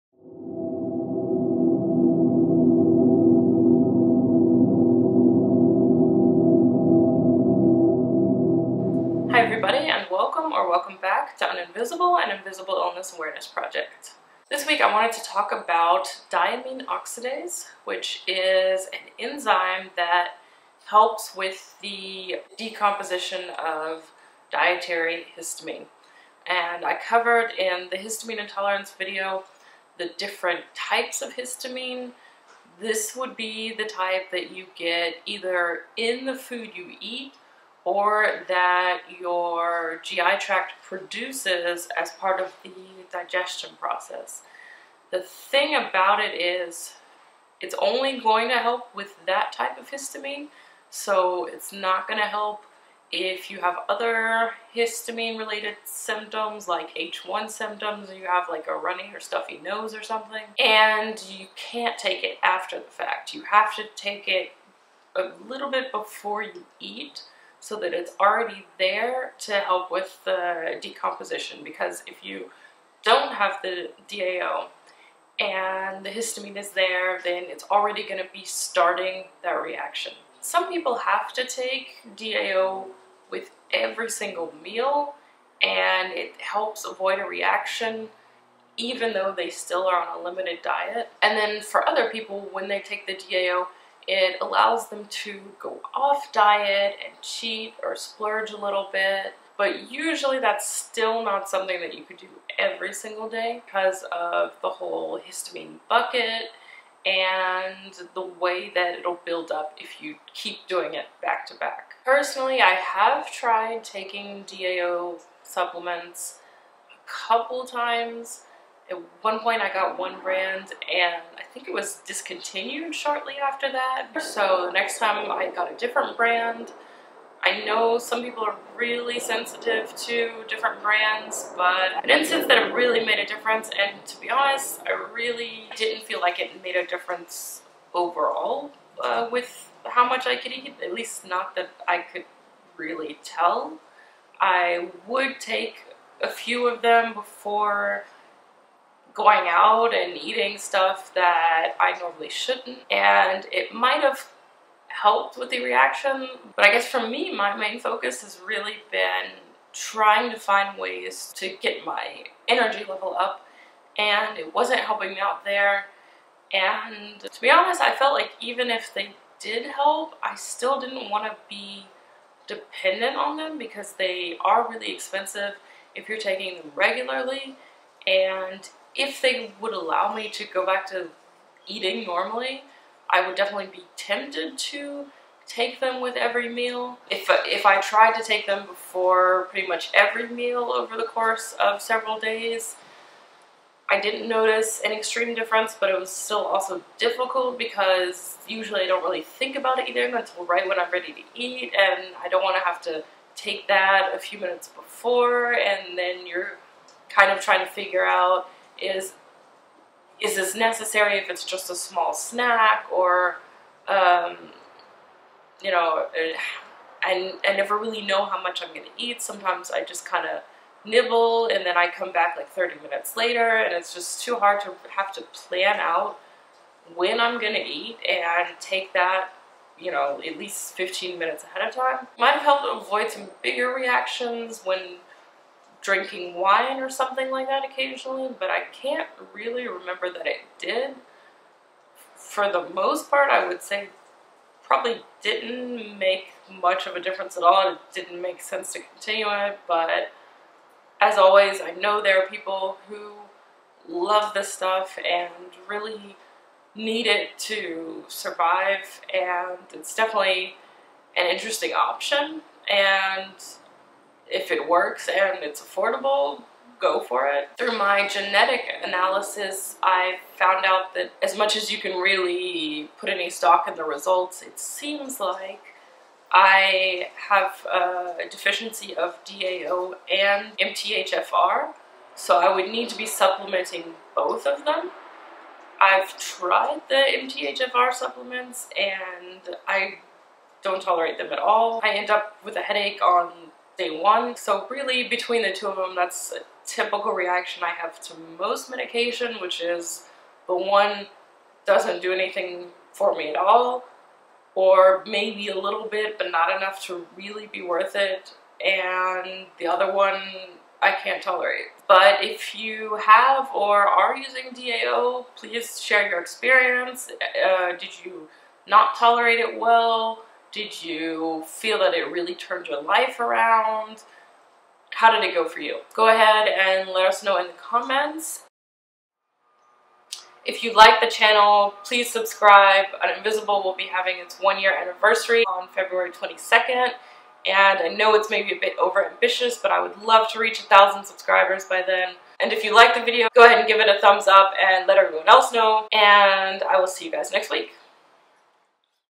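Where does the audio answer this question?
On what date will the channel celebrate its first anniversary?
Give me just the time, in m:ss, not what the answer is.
5:35.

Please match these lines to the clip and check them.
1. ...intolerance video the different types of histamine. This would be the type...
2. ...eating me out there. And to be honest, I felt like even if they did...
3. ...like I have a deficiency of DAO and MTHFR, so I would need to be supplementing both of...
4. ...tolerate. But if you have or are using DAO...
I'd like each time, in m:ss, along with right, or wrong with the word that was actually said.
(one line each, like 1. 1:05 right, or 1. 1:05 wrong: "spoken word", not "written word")
1. 0:28 right
2. 2:44 wrong: "helping", not "eating"
3. 4:35 right
4. 5:11 right.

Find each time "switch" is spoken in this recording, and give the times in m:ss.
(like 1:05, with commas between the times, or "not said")
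not said.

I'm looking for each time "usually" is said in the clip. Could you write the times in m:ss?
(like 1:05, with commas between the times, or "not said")
1:39, 3:18.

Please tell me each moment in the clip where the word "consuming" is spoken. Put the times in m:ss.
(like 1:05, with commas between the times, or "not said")
not said.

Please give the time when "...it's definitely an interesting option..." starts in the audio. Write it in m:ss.
4:19.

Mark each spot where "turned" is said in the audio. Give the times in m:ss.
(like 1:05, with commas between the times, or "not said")
5:22.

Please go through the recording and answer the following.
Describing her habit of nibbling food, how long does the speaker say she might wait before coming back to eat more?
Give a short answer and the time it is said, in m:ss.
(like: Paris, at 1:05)
30 minutes, at 3:42.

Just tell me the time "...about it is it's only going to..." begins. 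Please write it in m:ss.
0:45.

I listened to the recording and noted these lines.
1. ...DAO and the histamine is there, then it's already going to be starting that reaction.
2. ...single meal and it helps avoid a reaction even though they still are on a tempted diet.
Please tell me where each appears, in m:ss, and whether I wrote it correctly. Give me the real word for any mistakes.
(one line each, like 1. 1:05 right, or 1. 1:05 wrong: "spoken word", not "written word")
1. 1:14 right
2. 1:24 wrong: "limited", not "tempted".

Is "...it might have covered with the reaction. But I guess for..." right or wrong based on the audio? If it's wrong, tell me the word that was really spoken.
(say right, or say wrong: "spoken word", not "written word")
wrong: "helped", not "covered".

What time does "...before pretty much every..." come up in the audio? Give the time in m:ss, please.
3:08.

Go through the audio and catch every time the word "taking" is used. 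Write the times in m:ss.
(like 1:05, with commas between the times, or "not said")
1:53, 2:56.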